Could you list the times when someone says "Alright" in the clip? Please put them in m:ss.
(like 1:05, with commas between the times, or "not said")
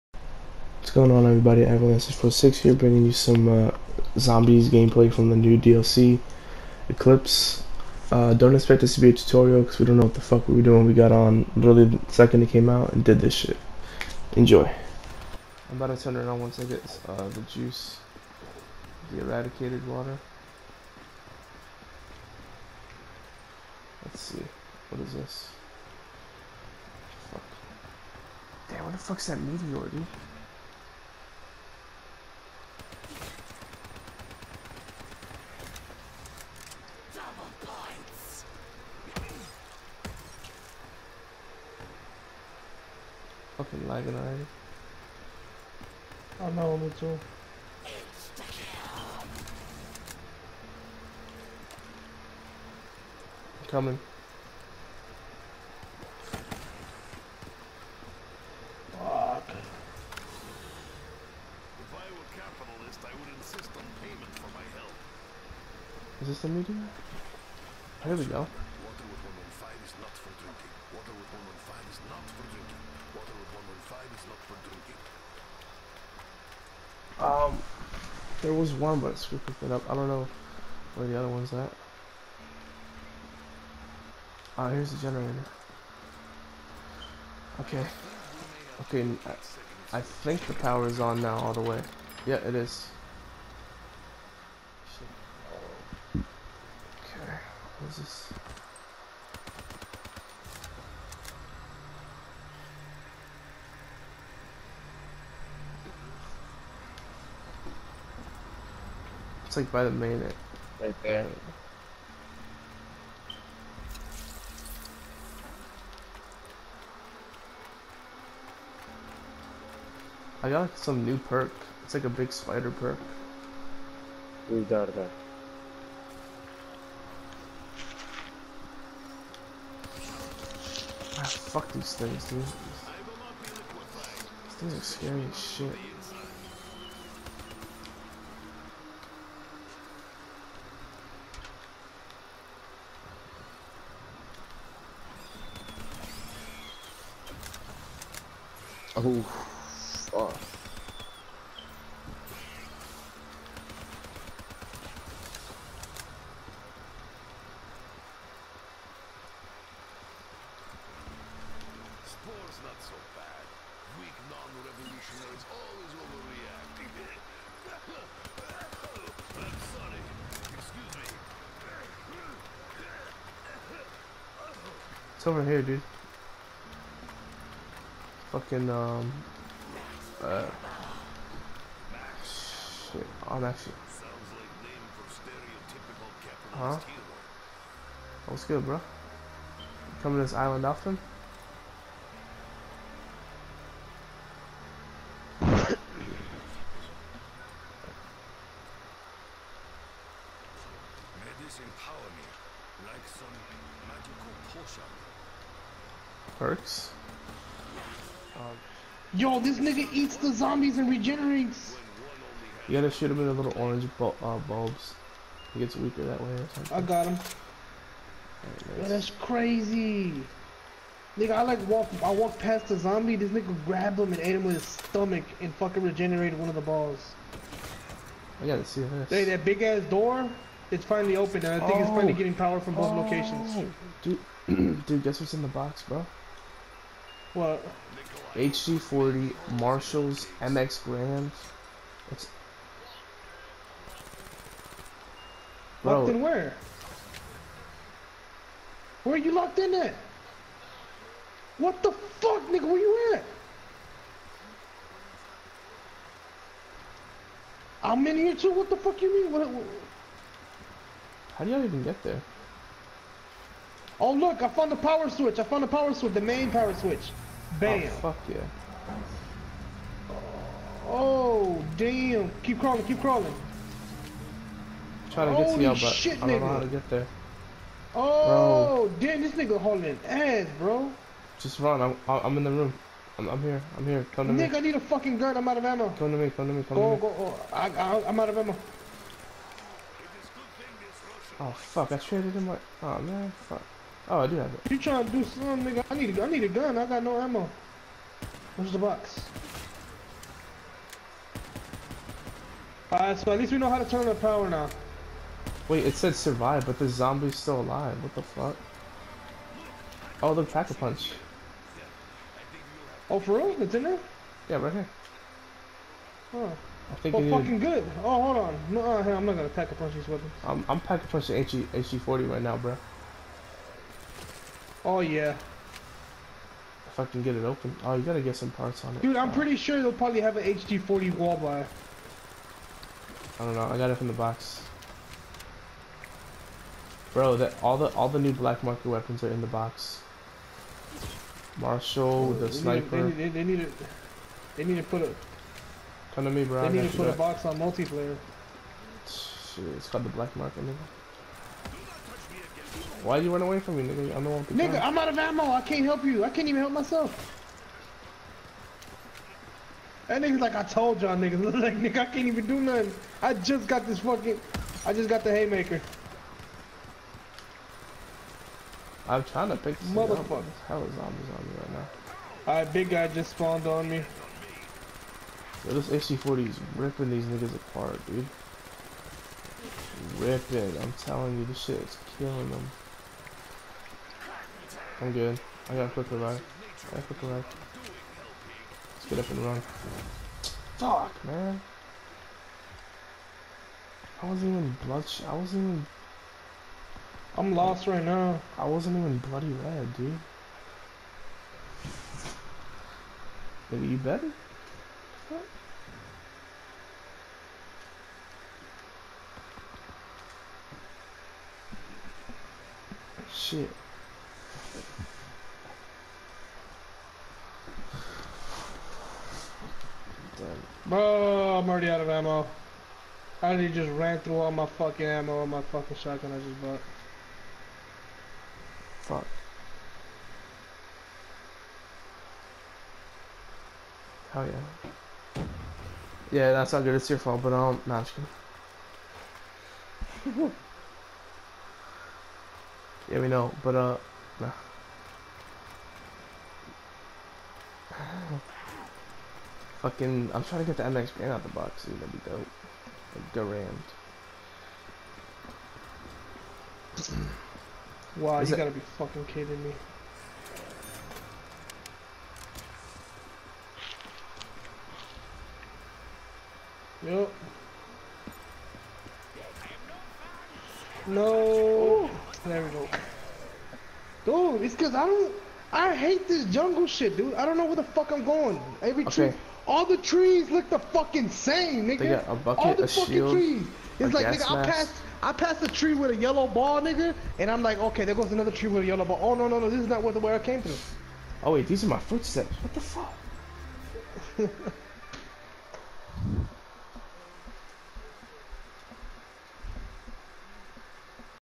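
5:02, 6:12.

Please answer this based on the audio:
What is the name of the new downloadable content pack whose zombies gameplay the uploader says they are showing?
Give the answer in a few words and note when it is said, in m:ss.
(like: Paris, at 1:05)
Eclipse, at 0:06.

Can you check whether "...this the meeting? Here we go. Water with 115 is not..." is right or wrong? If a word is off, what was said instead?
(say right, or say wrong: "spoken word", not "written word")
right.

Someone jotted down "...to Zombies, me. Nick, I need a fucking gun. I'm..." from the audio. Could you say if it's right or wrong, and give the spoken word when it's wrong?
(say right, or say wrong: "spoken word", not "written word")
wrong: "Nick", not "Zombies".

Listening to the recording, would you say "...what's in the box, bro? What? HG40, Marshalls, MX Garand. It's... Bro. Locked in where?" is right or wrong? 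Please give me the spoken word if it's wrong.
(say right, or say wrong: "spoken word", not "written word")
right.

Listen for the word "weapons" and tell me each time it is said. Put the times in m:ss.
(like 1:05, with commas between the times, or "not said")
5:20, 5:38.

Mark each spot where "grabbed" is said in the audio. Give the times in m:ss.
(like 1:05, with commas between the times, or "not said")
3:43.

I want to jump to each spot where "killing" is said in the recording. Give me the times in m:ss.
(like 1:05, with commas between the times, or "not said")
6:22.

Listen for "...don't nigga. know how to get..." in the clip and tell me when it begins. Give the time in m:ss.
4:36.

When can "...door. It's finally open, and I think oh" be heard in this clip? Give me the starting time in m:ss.
3:49.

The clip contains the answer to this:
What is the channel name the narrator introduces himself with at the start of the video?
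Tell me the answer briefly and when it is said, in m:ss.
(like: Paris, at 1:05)
Avalanche Pro 6, at 0:01.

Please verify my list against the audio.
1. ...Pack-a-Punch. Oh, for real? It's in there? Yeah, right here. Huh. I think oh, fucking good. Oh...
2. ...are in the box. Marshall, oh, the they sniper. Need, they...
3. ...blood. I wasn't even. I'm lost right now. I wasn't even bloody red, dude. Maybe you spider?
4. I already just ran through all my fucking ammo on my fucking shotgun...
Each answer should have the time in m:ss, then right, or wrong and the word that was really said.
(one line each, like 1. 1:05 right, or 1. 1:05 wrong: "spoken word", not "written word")
1. 5:10 right
2. 5:39 right
3. 6:34 wrong: "better", not "spider"
4. 7:03 right.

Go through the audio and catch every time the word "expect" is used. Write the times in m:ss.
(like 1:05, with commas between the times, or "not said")
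0:08.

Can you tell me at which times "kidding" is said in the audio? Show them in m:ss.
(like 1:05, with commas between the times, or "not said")
7:20, 7:39.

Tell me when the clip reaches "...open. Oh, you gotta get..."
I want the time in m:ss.
5:27.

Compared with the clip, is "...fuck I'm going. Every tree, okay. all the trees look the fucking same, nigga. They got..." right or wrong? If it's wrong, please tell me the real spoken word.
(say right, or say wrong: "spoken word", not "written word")
right.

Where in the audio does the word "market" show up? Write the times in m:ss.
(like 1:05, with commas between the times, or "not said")
5:38, 5:50.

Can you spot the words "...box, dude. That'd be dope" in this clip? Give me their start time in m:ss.
7:31.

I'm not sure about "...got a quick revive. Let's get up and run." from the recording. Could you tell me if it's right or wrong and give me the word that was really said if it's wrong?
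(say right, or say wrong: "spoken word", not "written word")
right.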